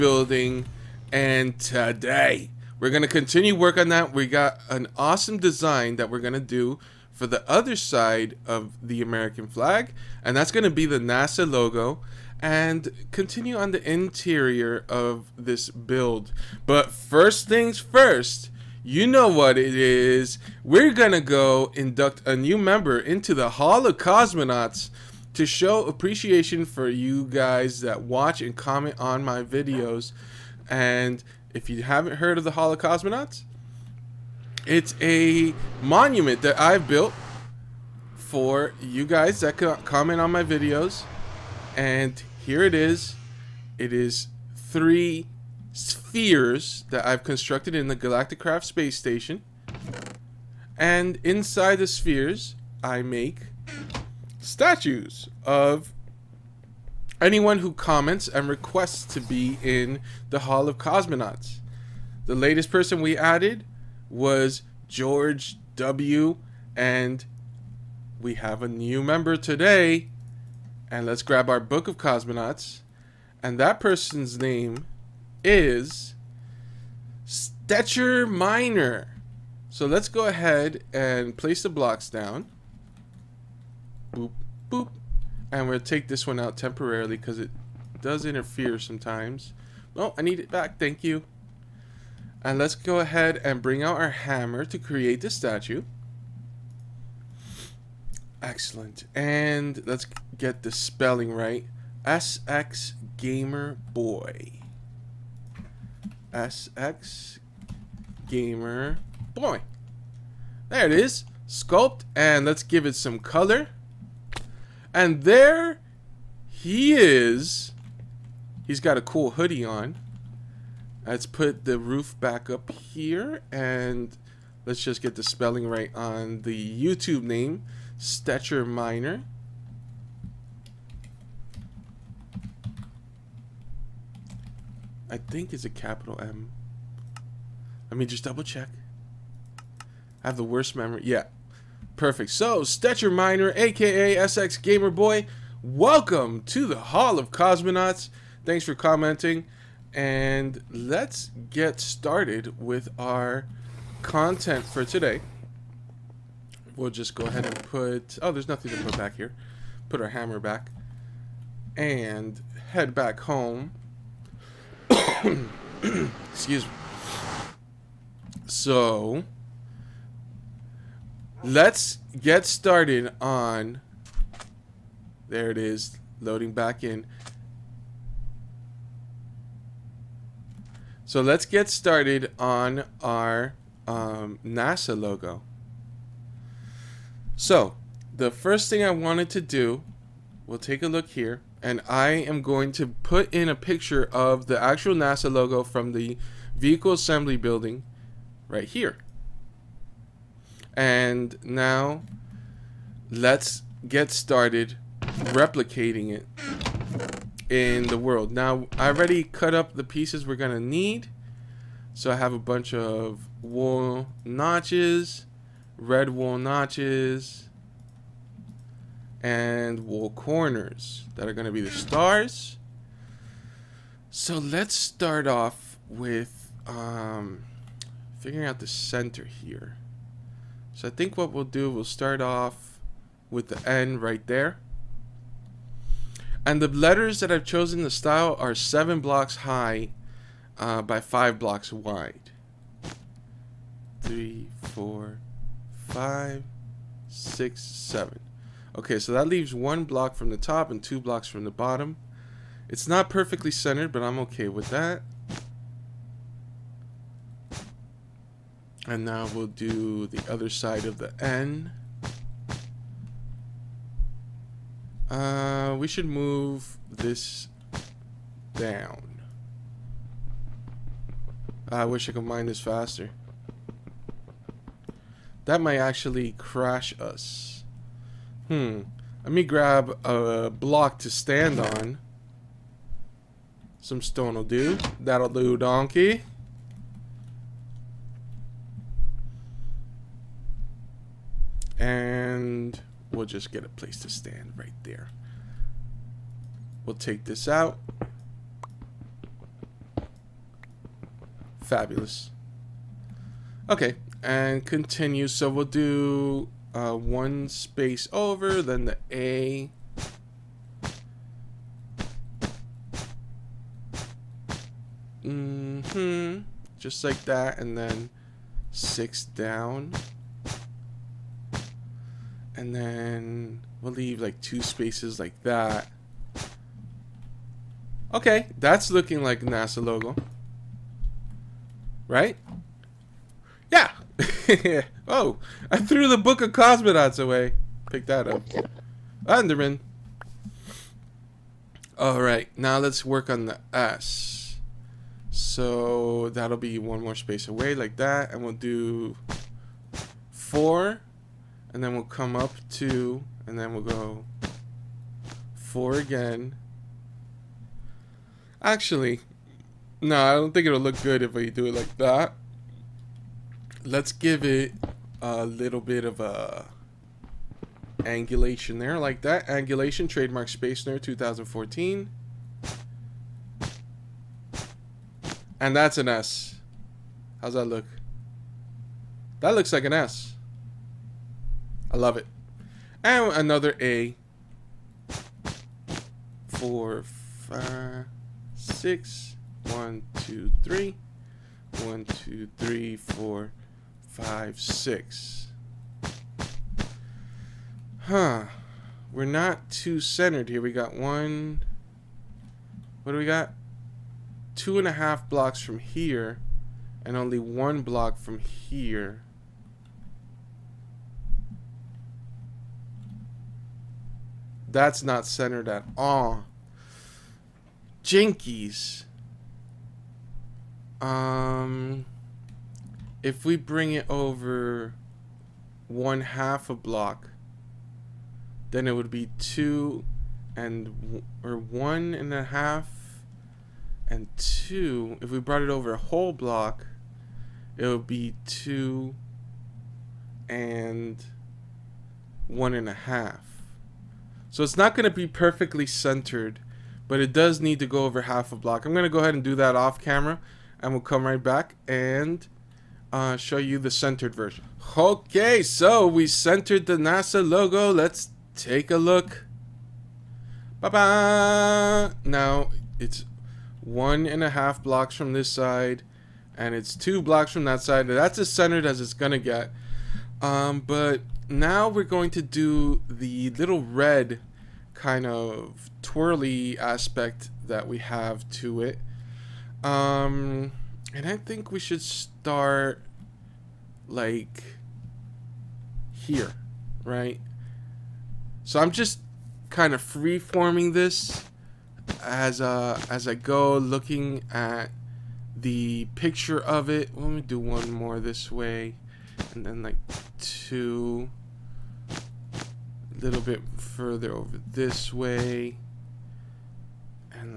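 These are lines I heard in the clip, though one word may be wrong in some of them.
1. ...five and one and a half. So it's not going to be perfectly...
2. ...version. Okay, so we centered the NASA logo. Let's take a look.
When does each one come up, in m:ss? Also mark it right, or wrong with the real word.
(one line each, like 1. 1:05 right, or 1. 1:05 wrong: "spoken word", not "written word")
1. 7:18 wrong: "two", not "five"
2. 7:34 right.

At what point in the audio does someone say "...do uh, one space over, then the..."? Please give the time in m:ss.
5:05.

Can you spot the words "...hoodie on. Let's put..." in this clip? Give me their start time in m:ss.
1:59.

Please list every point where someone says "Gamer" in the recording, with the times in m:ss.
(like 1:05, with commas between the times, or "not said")
1:43, 1:48, 2:24.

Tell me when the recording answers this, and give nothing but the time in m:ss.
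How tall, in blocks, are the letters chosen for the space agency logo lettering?
3:58.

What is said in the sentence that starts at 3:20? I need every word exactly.
And now, let's get started replicating it in the world.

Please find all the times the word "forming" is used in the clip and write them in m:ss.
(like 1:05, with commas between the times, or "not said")
8:10.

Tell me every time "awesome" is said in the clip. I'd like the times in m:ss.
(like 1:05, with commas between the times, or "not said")
0:04.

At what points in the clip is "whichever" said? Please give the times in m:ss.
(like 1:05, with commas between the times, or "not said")
not said.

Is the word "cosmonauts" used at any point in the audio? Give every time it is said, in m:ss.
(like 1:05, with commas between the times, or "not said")
0:23, 0:32, 1:00, 1:11, 2:27, 5:36.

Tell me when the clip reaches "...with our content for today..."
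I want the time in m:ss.
2:32.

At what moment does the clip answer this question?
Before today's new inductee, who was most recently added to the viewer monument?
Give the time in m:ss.
1:04.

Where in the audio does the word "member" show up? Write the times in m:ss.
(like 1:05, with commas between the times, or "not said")
0:22, 1:09.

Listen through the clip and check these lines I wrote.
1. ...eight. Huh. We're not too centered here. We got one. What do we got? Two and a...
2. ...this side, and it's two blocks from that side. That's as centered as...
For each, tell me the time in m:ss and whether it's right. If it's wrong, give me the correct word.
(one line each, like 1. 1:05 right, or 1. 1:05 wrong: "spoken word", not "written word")
1. 6:34 wrong: "six", not "eight"
2. 7:45 right.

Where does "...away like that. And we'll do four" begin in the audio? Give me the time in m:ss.
5:47.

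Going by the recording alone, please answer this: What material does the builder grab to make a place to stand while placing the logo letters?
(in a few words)
stone.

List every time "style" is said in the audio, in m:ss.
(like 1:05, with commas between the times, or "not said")
3:57.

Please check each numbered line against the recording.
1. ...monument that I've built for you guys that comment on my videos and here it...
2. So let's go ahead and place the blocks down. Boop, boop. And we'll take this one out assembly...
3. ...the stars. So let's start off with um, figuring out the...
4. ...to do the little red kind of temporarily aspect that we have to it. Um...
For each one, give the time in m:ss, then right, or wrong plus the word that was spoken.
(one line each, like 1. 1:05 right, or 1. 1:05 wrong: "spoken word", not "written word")
1. 0:35 right
2. 1:19 wrong: "temporarily", not "assembly"
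3. 3:41 right
4. 7:52 wrong: "twirly", not "temporarily".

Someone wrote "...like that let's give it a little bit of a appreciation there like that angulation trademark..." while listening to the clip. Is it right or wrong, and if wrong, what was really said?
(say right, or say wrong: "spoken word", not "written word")
wrong: "angulation", not "appreciation".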